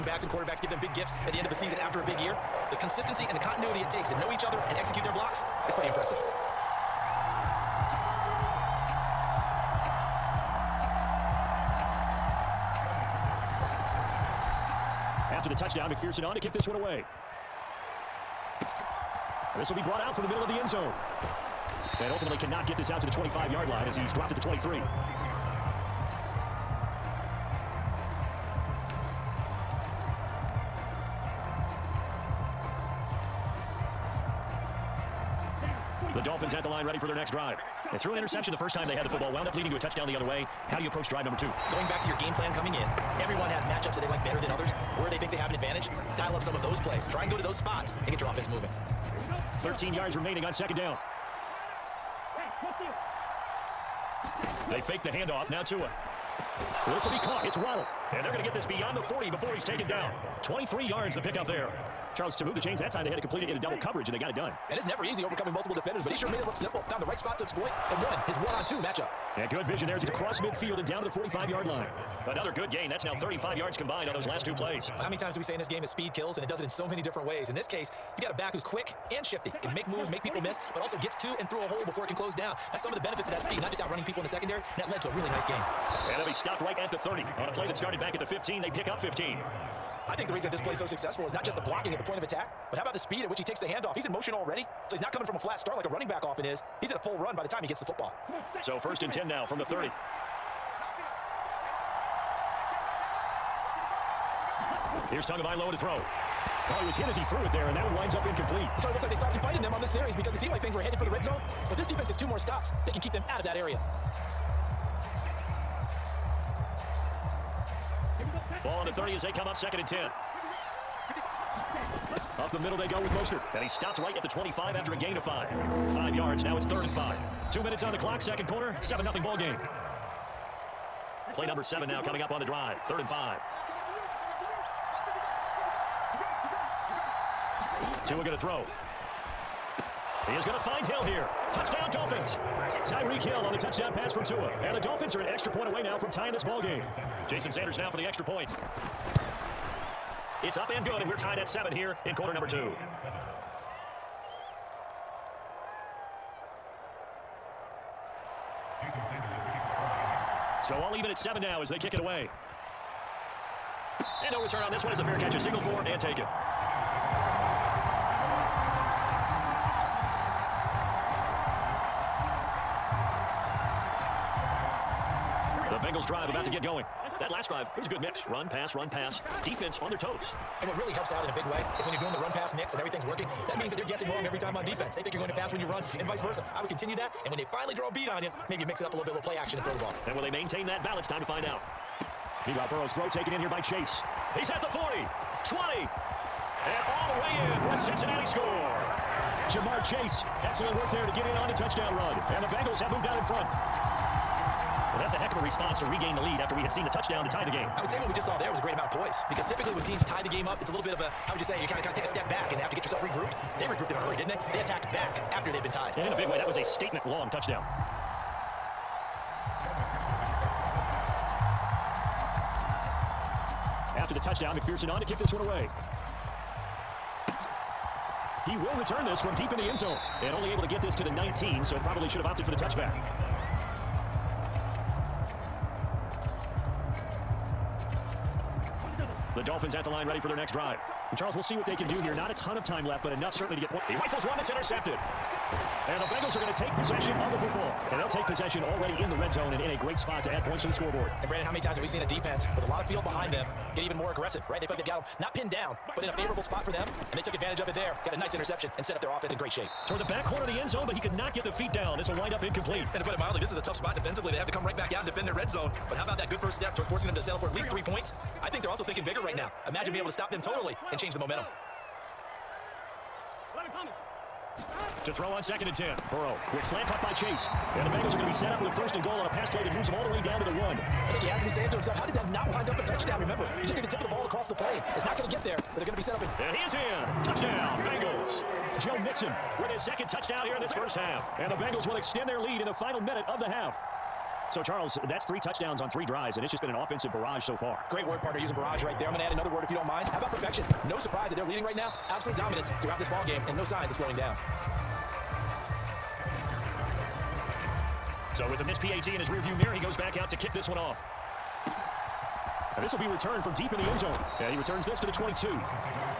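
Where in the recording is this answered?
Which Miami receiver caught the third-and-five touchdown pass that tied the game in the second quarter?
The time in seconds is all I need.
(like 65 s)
142 s.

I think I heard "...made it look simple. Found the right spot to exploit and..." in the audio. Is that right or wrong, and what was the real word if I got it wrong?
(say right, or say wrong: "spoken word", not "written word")
right.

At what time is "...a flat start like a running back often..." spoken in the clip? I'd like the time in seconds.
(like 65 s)
95 s.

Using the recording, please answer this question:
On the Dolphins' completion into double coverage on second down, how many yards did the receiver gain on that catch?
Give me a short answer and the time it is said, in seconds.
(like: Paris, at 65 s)
23, at 60 s.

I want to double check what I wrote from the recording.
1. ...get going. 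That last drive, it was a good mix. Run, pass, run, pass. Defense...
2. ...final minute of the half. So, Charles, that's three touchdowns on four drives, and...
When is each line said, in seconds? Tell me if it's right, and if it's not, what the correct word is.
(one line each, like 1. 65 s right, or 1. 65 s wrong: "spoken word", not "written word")
1. 176 s right
2. 292 s wrong: "three", not "four".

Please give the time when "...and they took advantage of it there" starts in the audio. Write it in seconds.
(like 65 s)
257 s.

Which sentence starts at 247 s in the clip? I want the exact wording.
And they'll take possession already in the red zone and in a great spot to add points to the scoreboard.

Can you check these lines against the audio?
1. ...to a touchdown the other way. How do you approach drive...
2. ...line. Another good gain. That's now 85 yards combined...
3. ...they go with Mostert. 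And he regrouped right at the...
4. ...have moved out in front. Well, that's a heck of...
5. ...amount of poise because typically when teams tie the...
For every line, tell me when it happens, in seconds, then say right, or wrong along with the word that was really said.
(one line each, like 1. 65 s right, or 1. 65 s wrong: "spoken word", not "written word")
1. 39 s right
2. 71 s wrong: "35", not "85"
3. 122 s wrong: "stopped", not "regrouped"
4. 202 s right
5. 208 s right.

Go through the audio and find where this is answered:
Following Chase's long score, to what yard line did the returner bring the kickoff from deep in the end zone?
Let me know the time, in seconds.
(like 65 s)
231 s.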